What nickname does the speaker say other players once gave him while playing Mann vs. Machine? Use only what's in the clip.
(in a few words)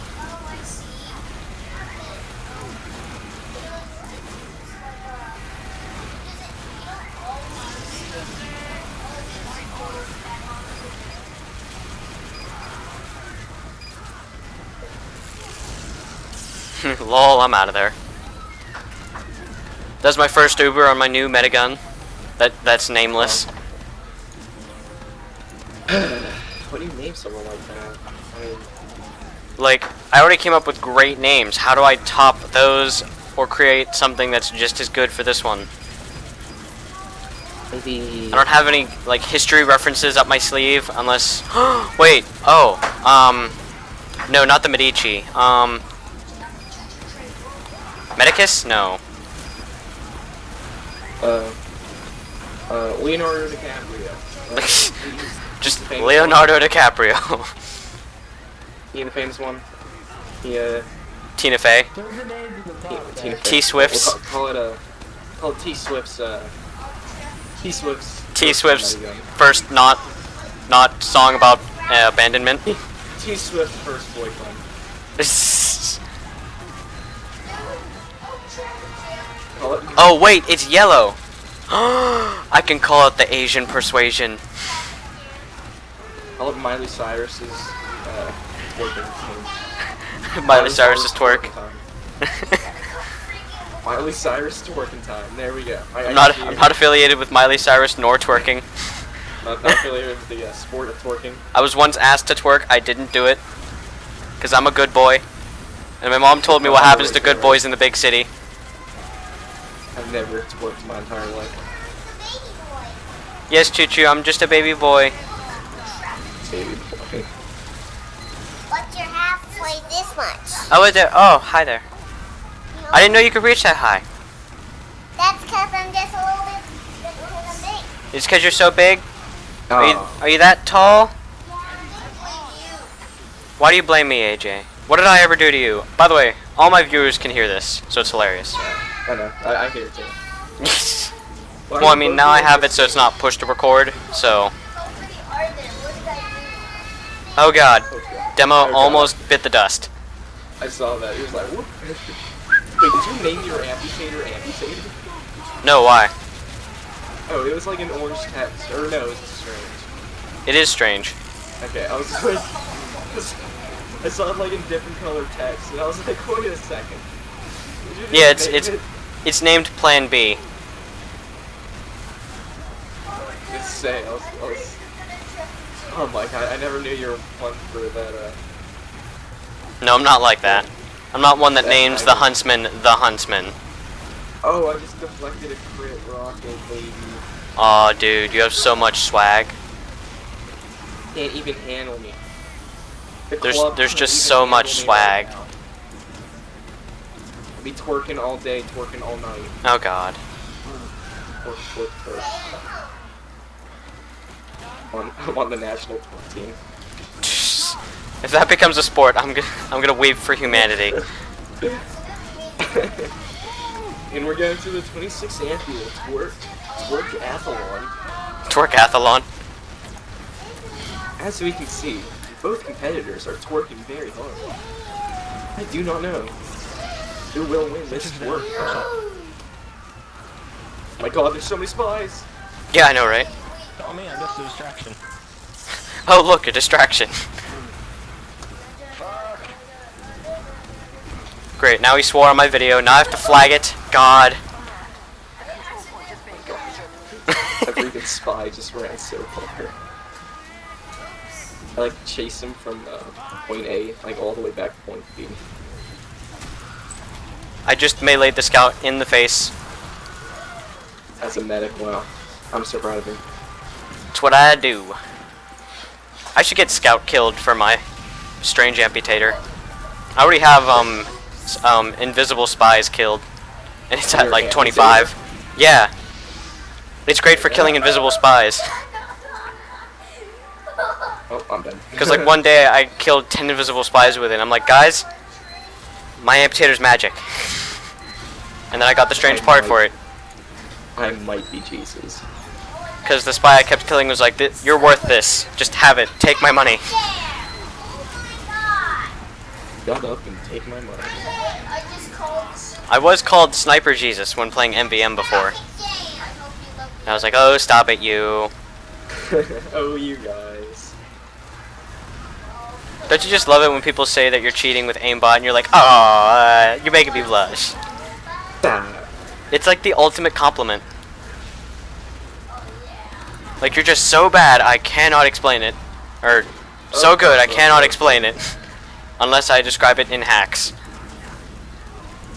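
Sniper Jesus.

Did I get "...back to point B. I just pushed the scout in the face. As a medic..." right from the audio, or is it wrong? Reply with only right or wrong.
wrong.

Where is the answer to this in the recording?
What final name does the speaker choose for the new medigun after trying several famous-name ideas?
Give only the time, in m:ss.
1:33.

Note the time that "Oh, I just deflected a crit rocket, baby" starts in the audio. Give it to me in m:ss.
3:04.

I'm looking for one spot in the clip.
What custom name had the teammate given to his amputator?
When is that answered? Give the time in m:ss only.
2:49.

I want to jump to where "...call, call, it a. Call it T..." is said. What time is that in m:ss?
1:04.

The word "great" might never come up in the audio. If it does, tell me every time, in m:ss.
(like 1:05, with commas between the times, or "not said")
0:30, 4:01, 4:37.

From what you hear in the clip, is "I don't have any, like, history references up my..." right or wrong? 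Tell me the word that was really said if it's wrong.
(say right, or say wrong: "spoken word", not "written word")
right.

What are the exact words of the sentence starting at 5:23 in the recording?
Like, you're just so bad, I cannot explain it.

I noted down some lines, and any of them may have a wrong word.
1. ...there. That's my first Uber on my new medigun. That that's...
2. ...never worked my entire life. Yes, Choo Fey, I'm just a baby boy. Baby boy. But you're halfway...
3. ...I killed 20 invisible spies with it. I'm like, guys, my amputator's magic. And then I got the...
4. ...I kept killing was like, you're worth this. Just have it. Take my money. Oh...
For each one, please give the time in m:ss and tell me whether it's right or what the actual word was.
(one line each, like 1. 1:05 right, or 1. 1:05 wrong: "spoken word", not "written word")
1. 0:17 right
2. 1:50 wrong: "Choo", not "Fey"
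3. 4:42 wrong: "10", not "20"
4. 4:53 right.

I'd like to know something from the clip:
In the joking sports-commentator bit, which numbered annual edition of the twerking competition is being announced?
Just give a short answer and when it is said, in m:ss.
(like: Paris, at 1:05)
26th, at 3:34.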